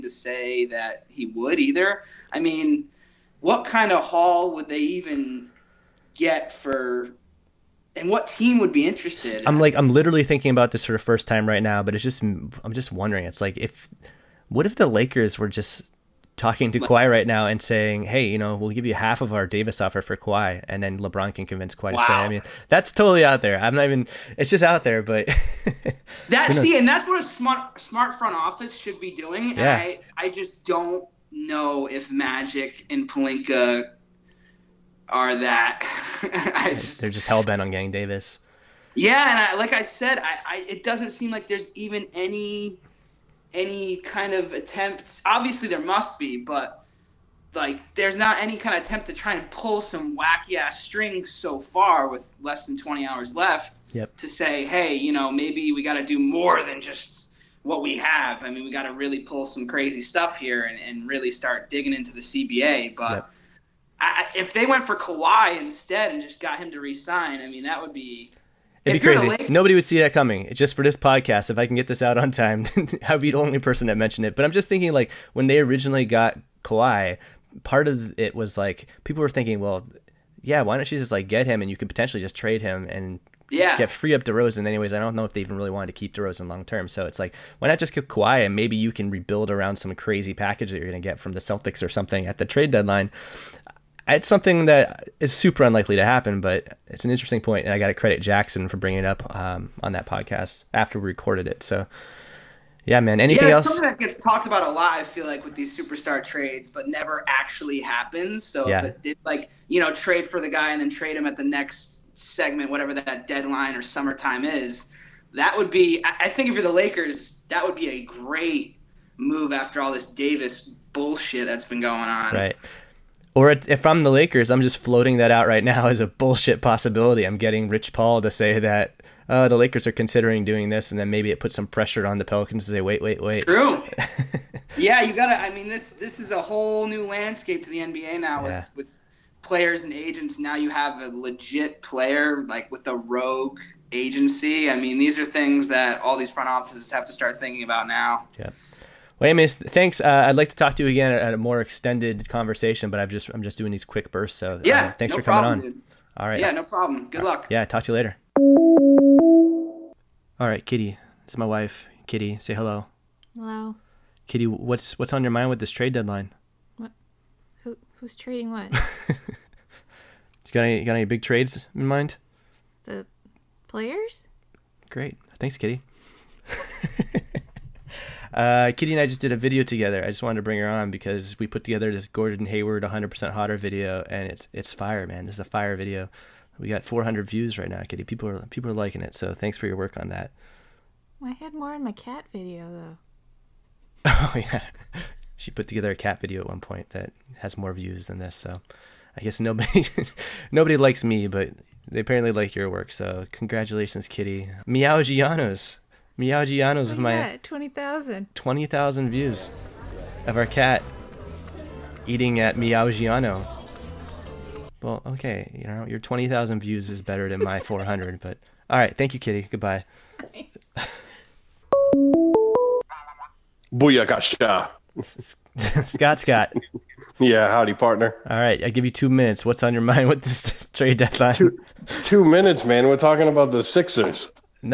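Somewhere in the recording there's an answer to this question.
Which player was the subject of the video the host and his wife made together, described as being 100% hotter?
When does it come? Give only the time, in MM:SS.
03:02.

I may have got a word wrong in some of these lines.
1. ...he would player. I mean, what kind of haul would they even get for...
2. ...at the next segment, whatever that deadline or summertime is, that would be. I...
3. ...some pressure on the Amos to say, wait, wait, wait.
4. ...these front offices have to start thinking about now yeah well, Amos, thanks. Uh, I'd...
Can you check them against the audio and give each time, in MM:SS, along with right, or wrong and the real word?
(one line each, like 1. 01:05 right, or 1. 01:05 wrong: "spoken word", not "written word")
1. 00:01 wrong: "either", not "player"
2. 01:51 right
3. 02:11 wrong: "Pelicans", not "Amos"
4. 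02:26 right.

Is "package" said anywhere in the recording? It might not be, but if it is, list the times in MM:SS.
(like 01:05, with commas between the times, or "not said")
01:30.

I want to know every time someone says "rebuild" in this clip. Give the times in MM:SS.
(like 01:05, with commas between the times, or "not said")
01:29.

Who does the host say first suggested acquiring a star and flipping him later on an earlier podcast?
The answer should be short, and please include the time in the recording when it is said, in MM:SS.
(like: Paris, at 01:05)
Jackson, at 01:38.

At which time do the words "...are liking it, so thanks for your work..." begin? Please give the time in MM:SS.
03:08.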